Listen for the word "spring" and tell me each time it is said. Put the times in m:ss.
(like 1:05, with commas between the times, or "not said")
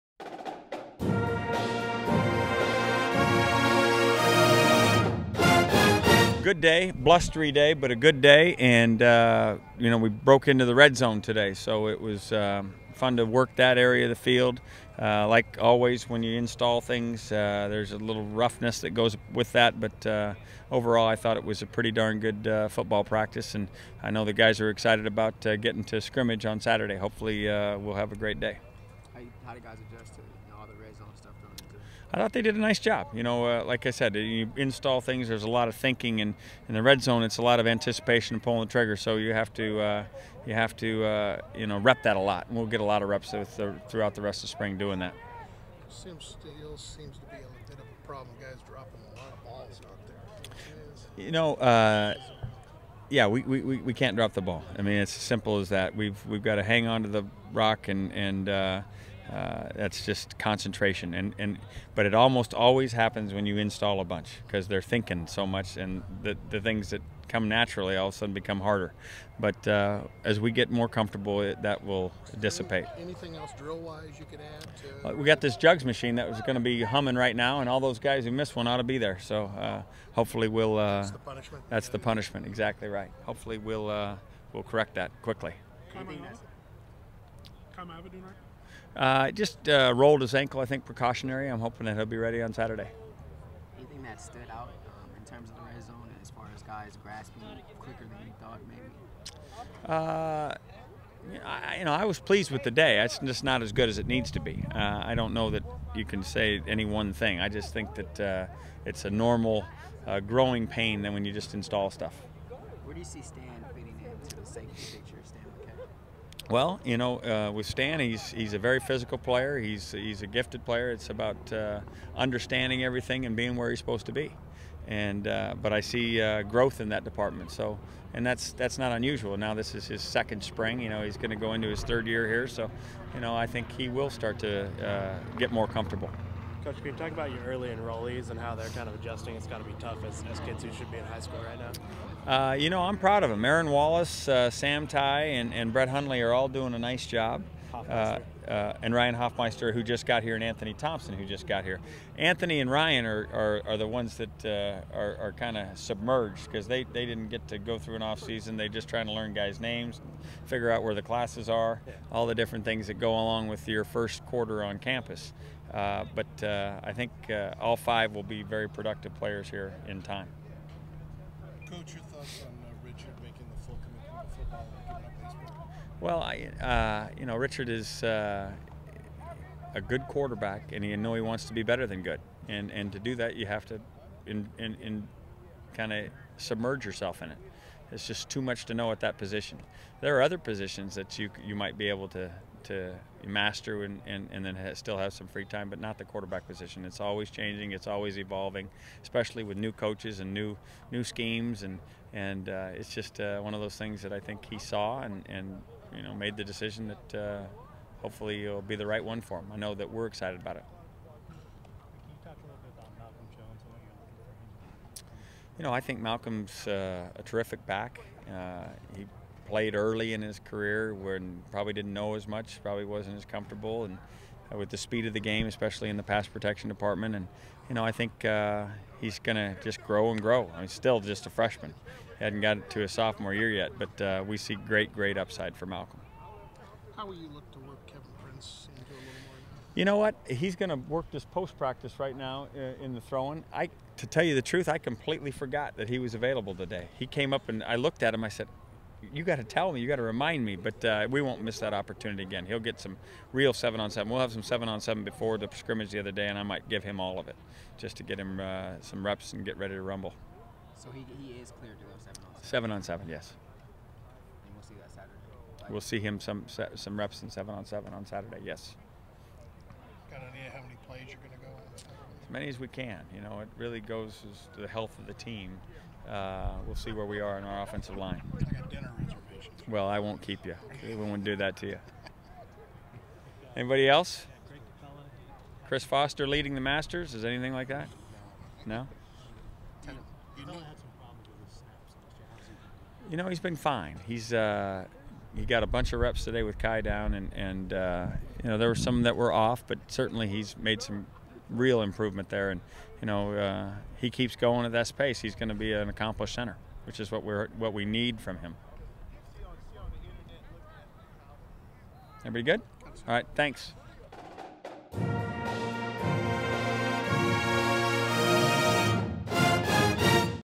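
0:44, 2:10.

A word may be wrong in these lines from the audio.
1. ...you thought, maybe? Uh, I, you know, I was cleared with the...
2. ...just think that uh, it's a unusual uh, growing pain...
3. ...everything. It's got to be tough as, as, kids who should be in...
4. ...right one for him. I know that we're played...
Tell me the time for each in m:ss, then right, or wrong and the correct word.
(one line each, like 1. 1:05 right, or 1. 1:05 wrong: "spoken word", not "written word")
1. 1:38 wrong: "pleased", not "cleared"
2. 1:47 wrong: "normal", not "unusual"
3. 2:18 wrong: "adjusting", not "everything"
4. 3:28 wrong: "excited", not "played".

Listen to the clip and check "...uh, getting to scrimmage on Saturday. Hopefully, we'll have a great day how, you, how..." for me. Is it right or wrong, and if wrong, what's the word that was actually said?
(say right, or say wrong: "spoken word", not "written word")
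right.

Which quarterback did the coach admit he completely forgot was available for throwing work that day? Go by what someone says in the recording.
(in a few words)
Kevin Prince.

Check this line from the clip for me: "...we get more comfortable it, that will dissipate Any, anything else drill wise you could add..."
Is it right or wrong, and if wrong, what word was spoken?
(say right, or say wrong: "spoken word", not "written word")
right.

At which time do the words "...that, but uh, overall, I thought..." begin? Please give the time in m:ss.
0:19.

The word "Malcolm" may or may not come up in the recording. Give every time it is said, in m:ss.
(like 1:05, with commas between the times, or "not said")
3:35, 3:55.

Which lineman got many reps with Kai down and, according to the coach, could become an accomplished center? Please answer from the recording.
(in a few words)
Chris Foster.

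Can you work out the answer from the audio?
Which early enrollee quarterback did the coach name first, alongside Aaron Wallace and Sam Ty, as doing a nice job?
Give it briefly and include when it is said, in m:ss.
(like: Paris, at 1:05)
Brett Hundley, at 2:25.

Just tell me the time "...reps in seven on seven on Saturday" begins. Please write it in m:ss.
4:26.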